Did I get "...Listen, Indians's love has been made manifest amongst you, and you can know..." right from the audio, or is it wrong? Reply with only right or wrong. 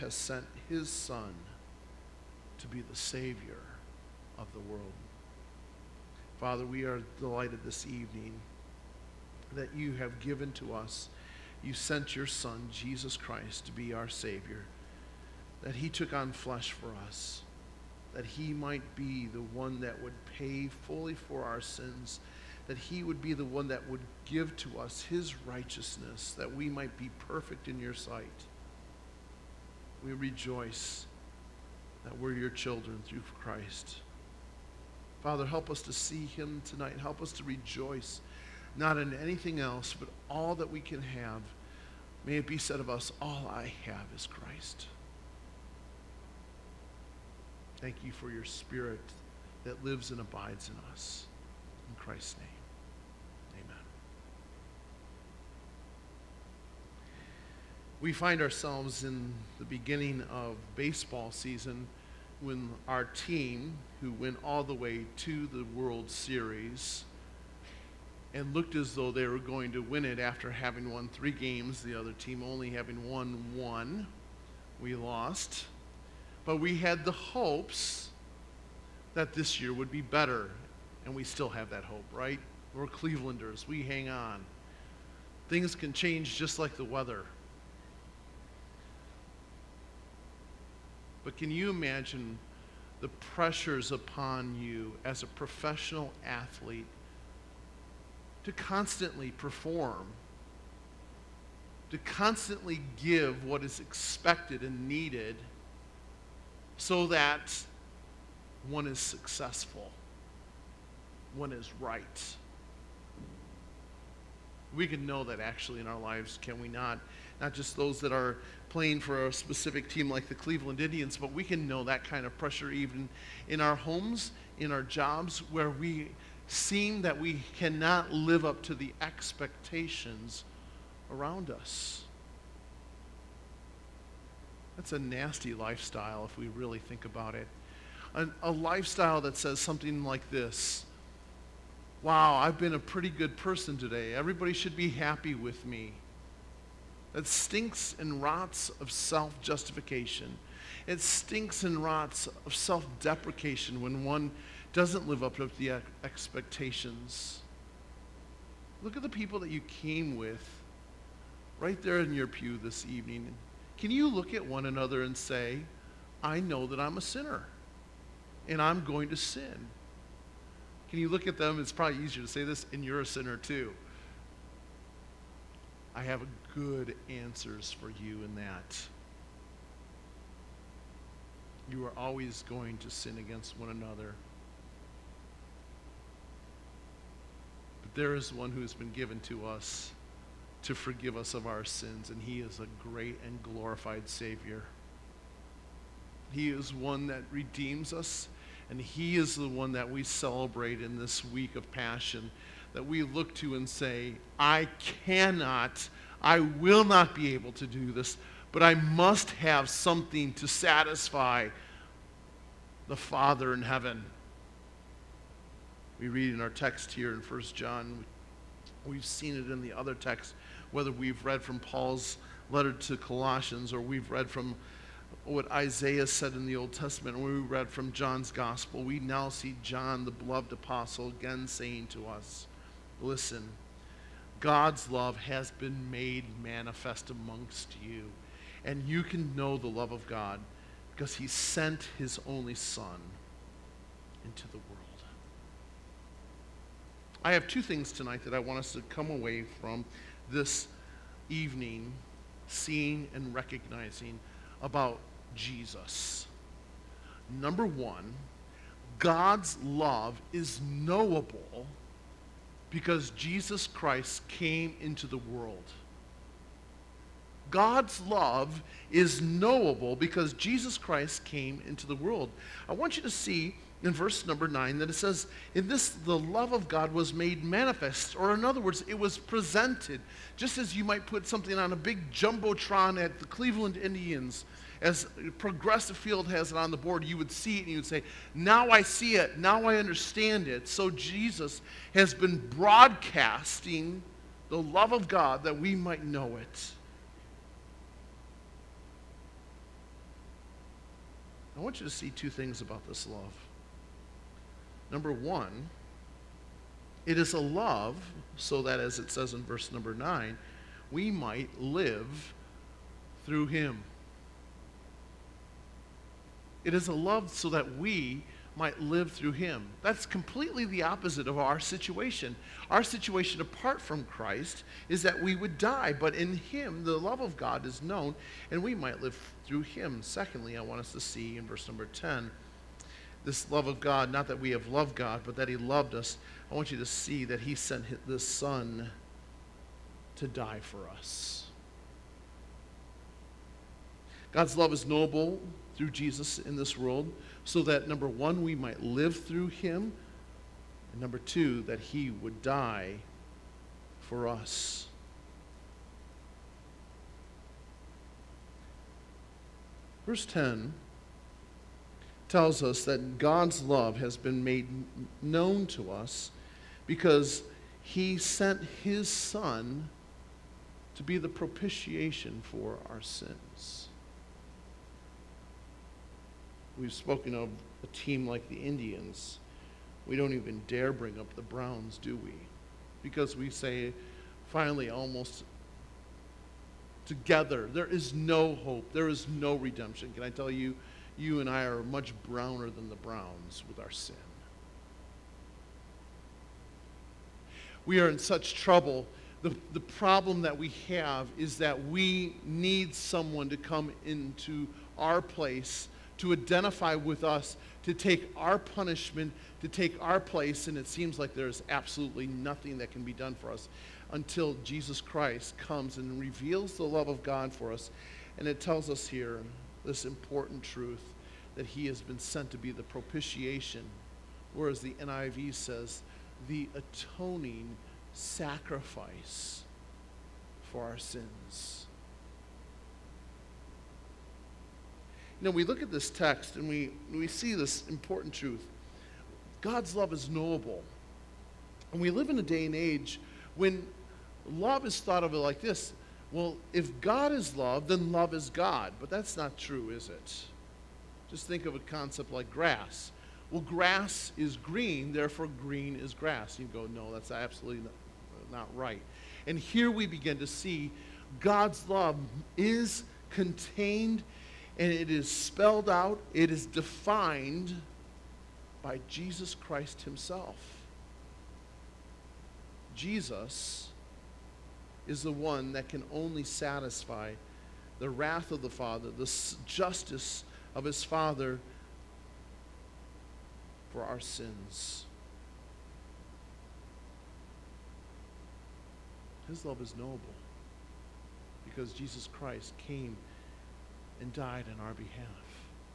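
wrong.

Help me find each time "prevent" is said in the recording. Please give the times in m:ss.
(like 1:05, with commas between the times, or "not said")
not said.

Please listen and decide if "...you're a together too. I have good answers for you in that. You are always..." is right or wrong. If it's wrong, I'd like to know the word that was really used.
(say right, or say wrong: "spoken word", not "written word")
wrong: "sinner", not "together".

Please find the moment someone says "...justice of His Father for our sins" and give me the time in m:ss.
7:59.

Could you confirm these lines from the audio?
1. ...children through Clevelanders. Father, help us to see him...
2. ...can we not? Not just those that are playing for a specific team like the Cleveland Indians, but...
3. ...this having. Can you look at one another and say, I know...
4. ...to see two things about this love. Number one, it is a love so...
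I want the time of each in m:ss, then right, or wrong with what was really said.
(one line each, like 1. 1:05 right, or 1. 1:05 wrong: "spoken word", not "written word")
1. 0:32 wrong: "Christ", not "Clevelanders"
2. 1:56 right
3. 2:42 wrong: "evening", not "having"
4. 5:01 right.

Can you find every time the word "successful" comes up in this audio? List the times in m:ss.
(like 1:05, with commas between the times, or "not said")
1:48.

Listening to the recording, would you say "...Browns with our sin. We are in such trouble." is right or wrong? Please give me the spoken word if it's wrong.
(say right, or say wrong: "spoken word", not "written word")
right.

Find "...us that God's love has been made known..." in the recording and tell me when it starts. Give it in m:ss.
6:02.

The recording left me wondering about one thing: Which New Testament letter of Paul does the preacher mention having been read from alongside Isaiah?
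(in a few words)
Colossians.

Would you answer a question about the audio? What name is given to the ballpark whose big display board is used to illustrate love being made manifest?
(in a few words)
Progressive Field.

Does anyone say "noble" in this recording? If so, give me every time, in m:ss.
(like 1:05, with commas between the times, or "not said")
5:44, 8:09.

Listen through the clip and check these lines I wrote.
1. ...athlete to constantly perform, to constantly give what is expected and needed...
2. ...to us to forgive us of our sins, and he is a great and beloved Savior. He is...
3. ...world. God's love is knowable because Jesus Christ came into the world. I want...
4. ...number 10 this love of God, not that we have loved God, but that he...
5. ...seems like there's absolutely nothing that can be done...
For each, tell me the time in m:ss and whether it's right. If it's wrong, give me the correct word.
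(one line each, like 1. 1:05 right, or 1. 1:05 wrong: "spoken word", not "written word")
1. 1:36 right
2. 3:09 wrong: "glorified", not "beloved"
3. 4:25 right
4. 5:31 right
5. 6:50 right.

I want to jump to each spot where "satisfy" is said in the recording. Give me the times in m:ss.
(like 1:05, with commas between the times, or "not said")
3:30, 7:56.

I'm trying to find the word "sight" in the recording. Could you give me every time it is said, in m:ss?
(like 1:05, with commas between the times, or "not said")
0:27.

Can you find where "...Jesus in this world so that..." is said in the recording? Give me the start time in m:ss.
5:45.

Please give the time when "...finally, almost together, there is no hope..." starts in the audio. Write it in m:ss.
6:24.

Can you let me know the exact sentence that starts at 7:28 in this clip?
But that's not true, is it?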